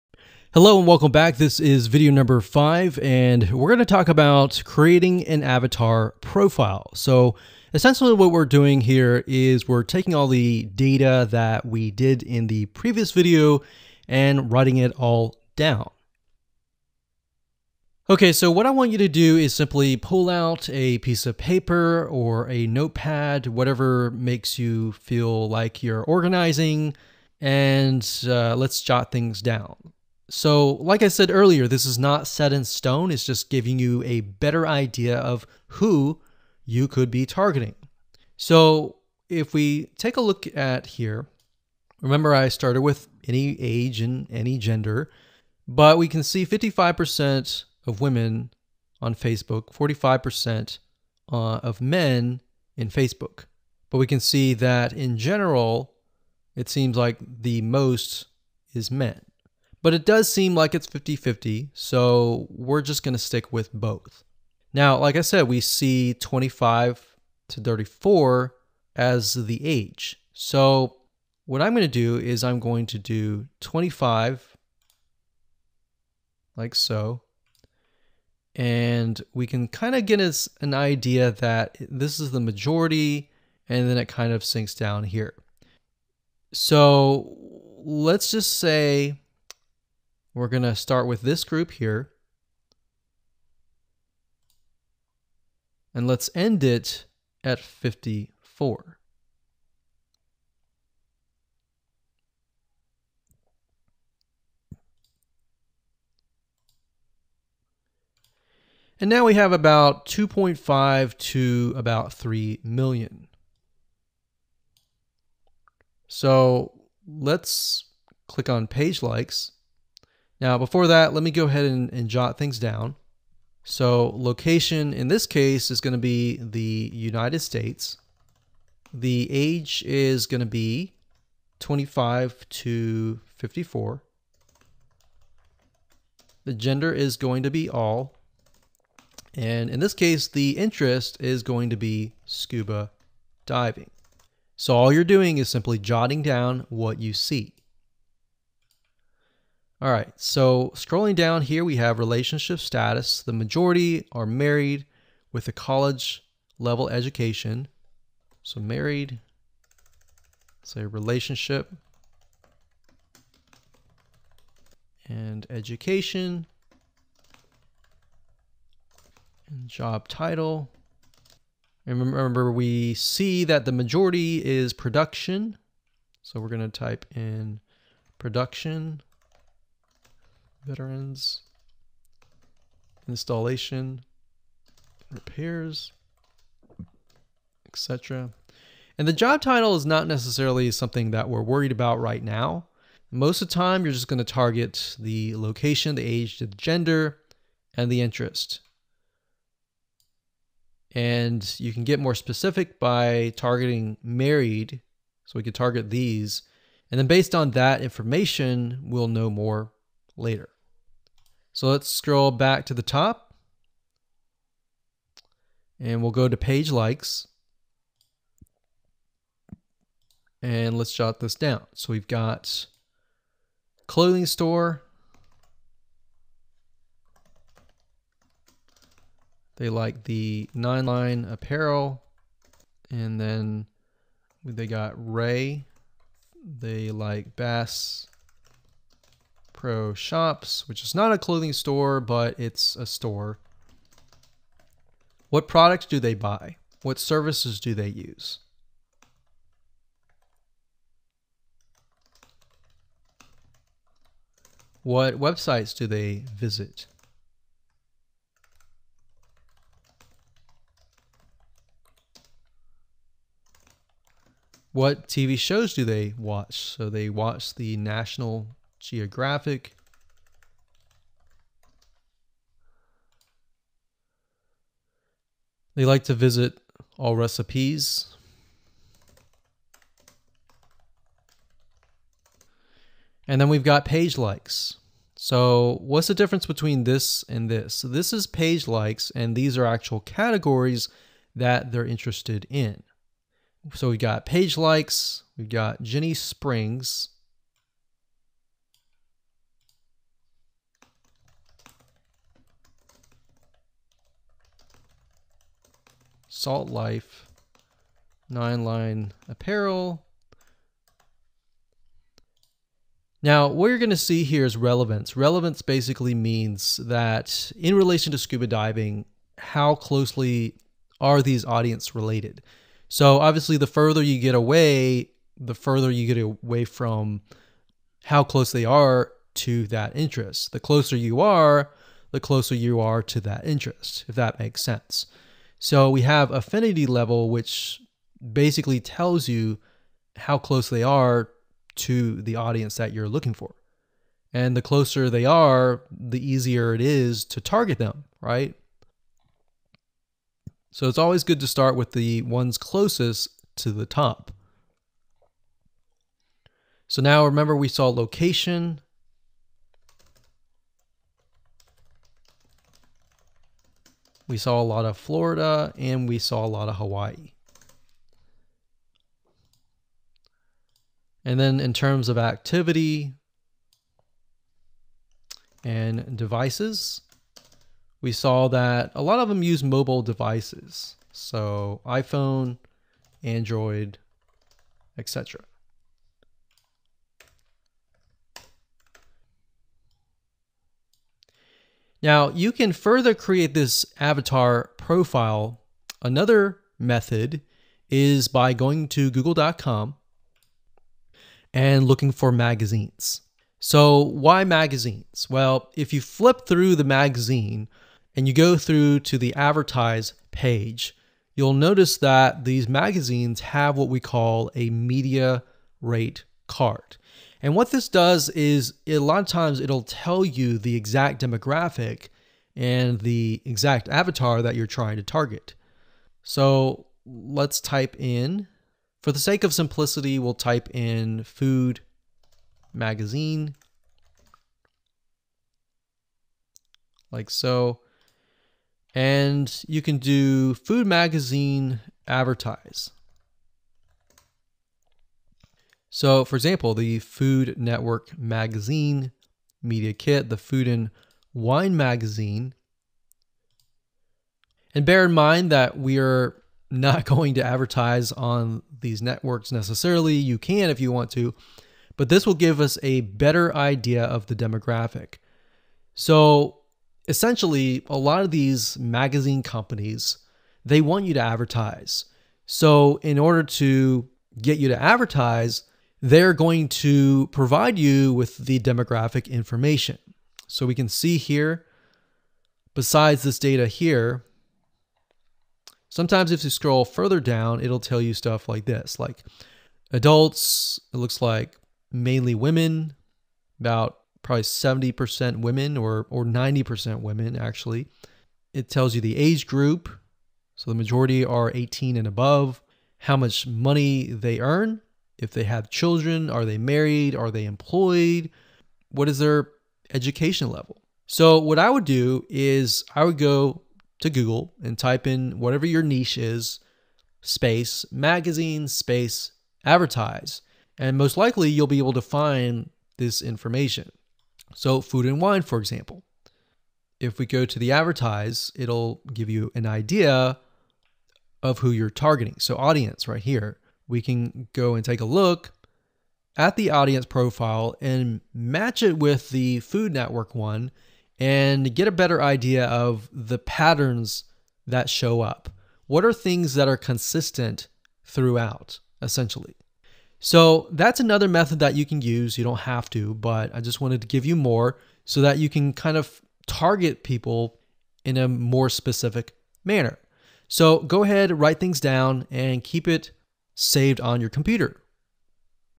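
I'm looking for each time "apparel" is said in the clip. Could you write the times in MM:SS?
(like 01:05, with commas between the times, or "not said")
03:51, 05:09.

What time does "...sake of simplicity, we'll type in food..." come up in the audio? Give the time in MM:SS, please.
07:09.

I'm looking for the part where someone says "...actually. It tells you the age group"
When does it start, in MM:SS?
08:17.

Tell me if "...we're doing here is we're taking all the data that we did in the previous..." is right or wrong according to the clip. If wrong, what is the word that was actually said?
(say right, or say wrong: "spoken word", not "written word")
right.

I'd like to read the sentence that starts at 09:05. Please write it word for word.
What are things that are consistent throughout, essentially?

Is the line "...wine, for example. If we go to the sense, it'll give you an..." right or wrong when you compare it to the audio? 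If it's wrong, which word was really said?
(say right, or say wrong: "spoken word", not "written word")
wrong: "advertise", not "sense".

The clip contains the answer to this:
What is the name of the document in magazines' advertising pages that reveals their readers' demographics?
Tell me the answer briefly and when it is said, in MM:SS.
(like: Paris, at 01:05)
Media rate card, at 06:54.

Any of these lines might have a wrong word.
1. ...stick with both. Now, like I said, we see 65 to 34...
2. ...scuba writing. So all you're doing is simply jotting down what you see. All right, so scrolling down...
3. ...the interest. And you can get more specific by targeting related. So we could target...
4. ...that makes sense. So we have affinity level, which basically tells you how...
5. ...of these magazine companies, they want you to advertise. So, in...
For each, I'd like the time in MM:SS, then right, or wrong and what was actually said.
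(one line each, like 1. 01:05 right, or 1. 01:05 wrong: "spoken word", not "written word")
1. 01:03 wrong: "25", not "65"
2. 02:22 wrong: "diving", not "writing"
3. 03:17 wrong: "married", not "related"
4. 05:34 right
5. 07:48 right.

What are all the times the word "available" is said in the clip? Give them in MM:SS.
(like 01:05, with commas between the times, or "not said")
not said.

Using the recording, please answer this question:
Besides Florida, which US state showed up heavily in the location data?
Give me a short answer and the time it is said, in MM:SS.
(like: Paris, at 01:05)
Hawaii, at 06:06.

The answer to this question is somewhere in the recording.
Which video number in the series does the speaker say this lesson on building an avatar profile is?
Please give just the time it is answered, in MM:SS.
00:02.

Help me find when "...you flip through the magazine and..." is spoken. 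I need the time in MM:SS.
06:45.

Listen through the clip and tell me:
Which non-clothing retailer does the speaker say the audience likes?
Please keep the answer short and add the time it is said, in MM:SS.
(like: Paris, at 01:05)
Bass Pro Shops, at 03:57.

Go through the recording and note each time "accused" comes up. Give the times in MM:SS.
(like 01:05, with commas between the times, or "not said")
not said.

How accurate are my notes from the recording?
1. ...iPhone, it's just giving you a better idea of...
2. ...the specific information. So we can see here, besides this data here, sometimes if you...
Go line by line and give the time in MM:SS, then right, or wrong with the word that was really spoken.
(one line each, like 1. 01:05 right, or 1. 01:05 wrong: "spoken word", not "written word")
1. 00:32 wrong: "stone", not "iPhone"
2. 07:58 wrong: "demographic", not "specific".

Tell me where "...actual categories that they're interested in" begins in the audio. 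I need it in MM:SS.
04:49.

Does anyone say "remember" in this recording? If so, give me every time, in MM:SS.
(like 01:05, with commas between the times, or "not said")
00:42, 02:51, 05:57.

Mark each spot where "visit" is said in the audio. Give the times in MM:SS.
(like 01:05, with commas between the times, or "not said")
04:16, 04:36.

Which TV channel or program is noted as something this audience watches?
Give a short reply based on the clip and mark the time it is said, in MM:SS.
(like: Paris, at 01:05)
National Geographic, at 04:27.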